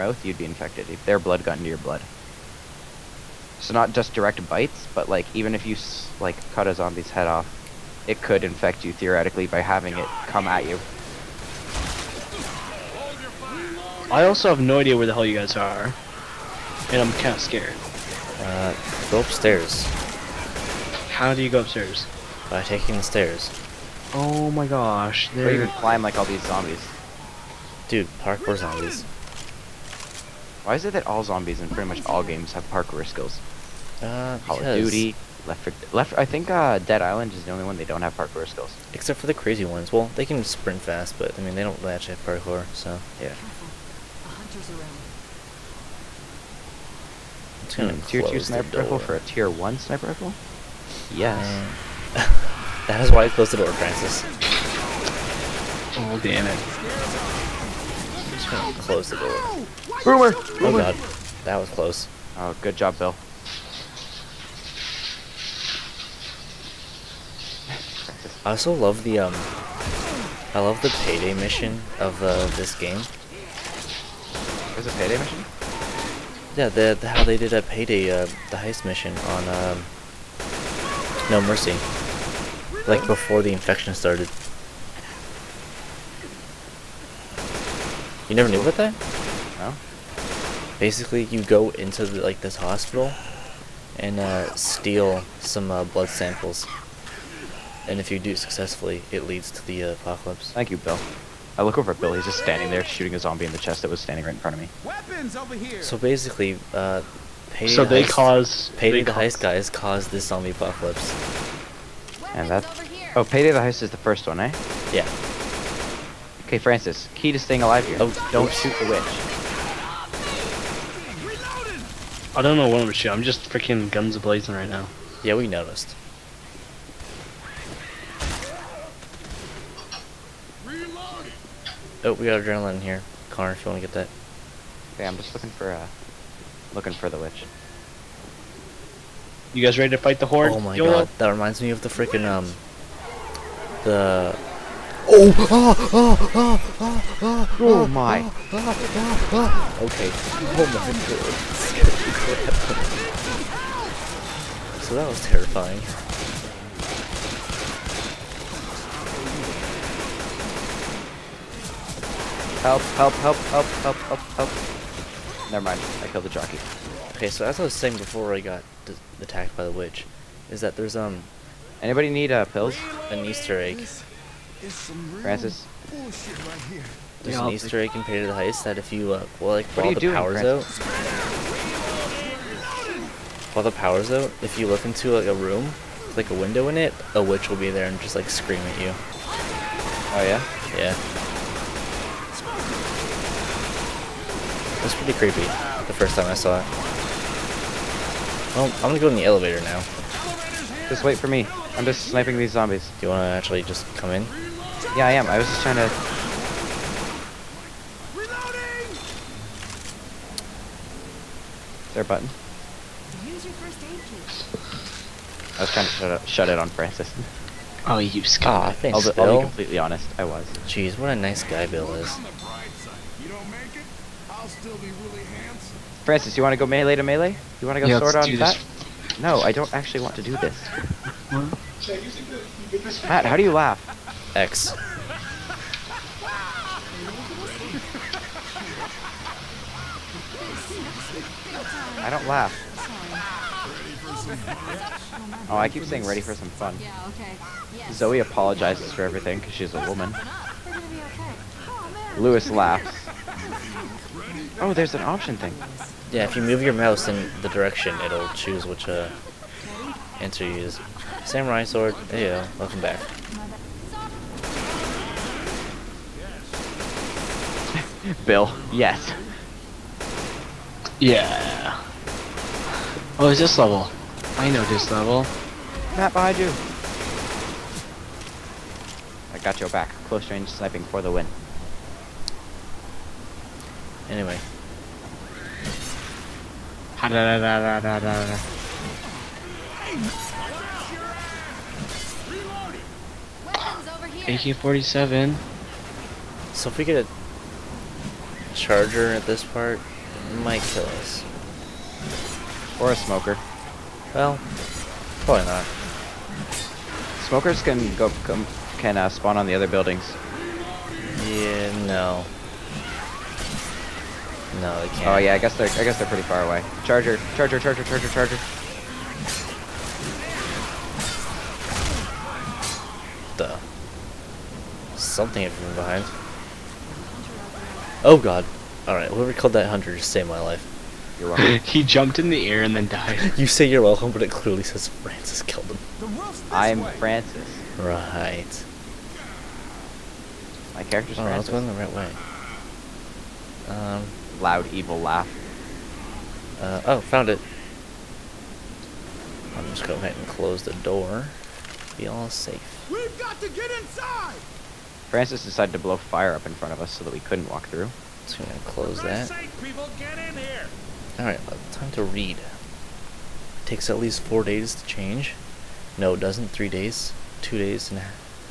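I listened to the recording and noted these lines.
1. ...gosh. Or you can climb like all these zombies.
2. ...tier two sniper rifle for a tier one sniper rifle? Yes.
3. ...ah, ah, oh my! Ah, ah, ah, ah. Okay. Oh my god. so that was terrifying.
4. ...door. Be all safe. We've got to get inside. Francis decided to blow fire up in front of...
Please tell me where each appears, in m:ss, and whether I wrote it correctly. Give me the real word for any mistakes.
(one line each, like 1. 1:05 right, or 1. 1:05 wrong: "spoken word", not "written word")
1. 0:24 right
2. 0:48 right
3. 2:26 right
4. 5:50 right.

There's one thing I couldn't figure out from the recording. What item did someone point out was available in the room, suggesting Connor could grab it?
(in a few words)
Adrenaline.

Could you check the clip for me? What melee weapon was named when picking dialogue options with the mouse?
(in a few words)
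Samurai sword.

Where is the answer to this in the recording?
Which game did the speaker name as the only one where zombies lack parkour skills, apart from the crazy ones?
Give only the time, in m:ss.
0:36.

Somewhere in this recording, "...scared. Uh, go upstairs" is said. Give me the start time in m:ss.
0:17.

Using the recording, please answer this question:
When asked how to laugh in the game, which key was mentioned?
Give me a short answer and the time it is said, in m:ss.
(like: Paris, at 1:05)
X, at 3:54.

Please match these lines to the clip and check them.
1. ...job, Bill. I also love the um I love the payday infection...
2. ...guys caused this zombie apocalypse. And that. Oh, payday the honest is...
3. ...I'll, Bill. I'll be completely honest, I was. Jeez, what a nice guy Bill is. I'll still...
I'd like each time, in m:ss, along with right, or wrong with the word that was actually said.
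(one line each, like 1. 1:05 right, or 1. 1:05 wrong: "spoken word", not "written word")
1. 1:02 wrong: "mission", not "infection"
2. 1:49 wrong: "heist", not "honest"
3. 3:39 right.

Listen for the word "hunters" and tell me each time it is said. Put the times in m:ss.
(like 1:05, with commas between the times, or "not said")
0:44, 5:29.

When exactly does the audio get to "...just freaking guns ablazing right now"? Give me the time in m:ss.
2:03.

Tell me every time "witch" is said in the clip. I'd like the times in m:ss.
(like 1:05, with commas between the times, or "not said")
1:58, 2:17, 2:49, 3:07.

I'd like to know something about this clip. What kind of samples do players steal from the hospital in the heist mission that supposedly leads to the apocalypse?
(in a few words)
Blood samples.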